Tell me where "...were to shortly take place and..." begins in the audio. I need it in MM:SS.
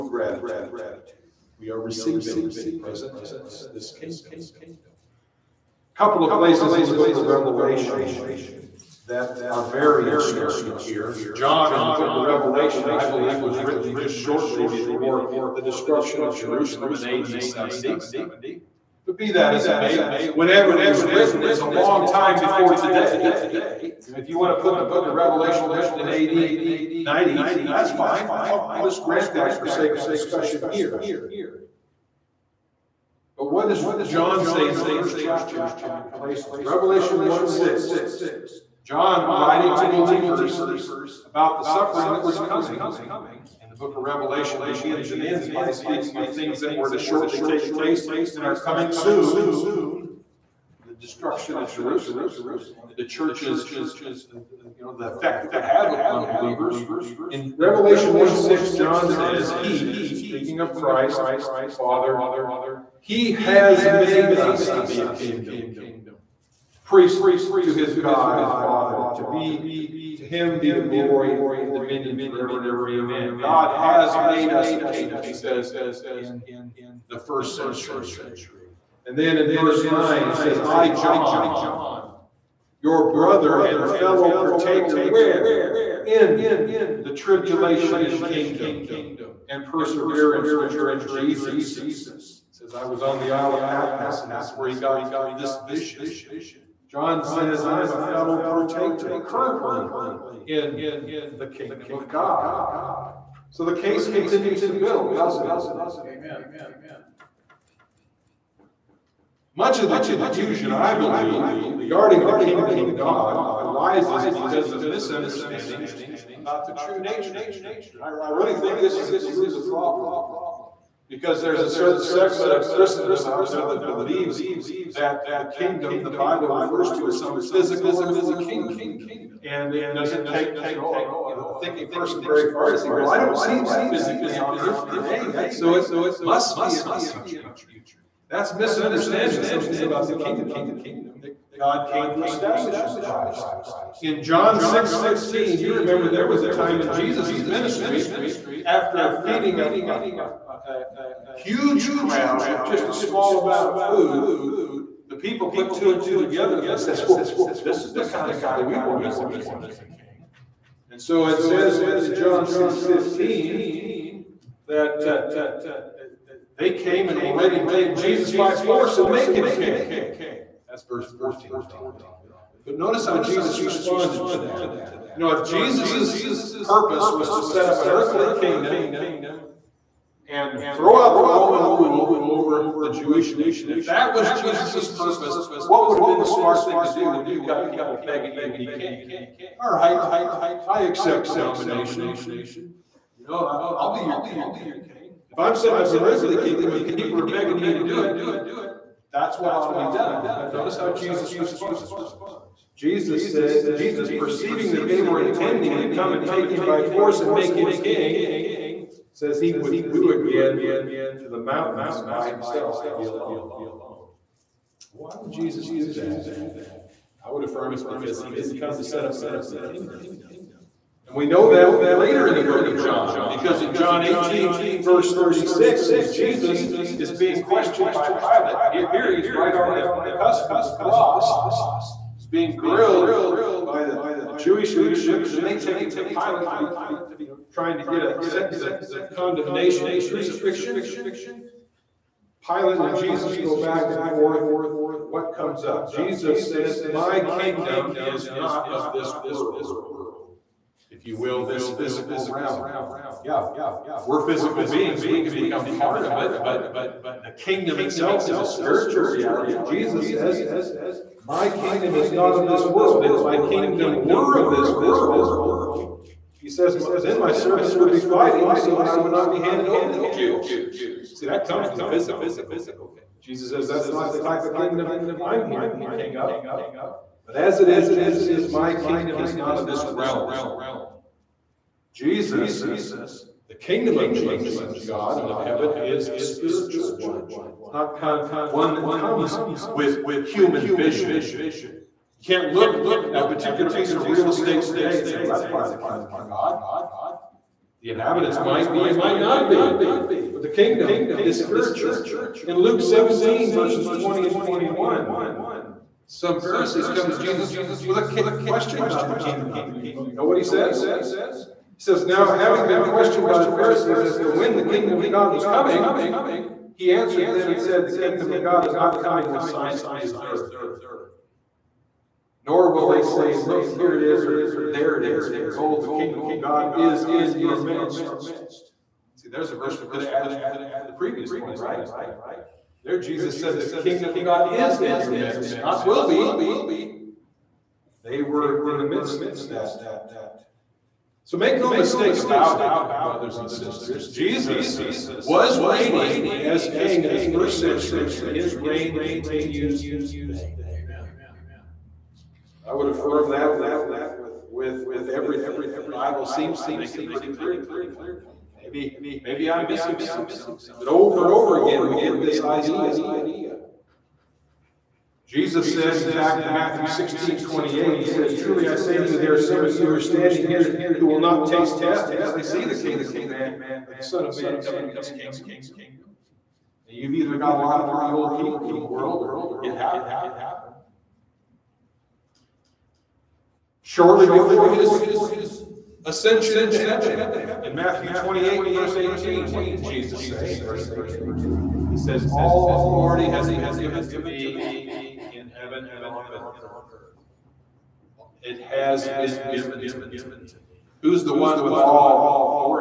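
00:46.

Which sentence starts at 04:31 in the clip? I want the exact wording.
See, that comes from the physical kingdom.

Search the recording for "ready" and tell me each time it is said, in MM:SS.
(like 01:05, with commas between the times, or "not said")
02:47.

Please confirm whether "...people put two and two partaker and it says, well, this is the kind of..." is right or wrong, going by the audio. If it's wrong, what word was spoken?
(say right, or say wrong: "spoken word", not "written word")
wrong: "together", not "partaker".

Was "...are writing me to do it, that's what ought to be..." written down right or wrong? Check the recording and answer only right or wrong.
wrong.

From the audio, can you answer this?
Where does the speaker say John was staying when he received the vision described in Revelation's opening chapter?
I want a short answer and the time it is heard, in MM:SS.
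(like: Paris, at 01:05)
Isle of Patmos, at 01:33.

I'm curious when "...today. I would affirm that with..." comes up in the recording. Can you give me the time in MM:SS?
05:50.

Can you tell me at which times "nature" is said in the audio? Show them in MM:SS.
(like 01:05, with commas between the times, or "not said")
01:56.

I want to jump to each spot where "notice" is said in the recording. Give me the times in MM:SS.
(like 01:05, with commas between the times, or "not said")
02:52, 03:20.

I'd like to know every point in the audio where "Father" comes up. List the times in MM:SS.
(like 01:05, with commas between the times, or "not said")
01:01, 01:08.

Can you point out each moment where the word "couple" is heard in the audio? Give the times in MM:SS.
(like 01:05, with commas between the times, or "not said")
00:06, 00:35.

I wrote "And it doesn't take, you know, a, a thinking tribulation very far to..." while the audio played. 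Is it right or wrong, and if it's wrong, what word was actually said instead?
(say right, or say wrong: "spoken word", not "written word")
wrong: "person", not "tribulation".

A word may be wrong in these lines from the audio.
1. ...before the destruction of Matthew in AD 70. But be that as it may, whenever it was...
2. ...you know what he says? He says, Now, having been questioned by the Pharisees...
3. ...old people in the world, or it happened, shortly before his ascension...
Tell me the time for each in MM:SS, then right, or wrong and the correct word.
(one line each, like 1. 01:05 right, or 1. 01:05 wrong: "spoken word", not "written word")
1. 00:14 wrong: "Jerusalem", not "Matthew"
2. 05:09 right
3. 06:18 right.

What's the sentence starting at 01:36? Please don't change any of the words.
John says, I'm a fellow partaker currently in the kingdom of God.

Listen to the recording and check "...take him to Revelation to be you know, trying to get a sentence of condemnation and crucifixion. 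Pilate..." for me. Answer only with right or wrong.
wrong.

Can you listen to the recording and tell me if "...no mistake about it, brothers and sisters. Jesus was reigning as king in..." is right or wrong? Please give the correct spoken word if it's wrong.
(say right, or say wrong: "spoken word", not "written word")
right.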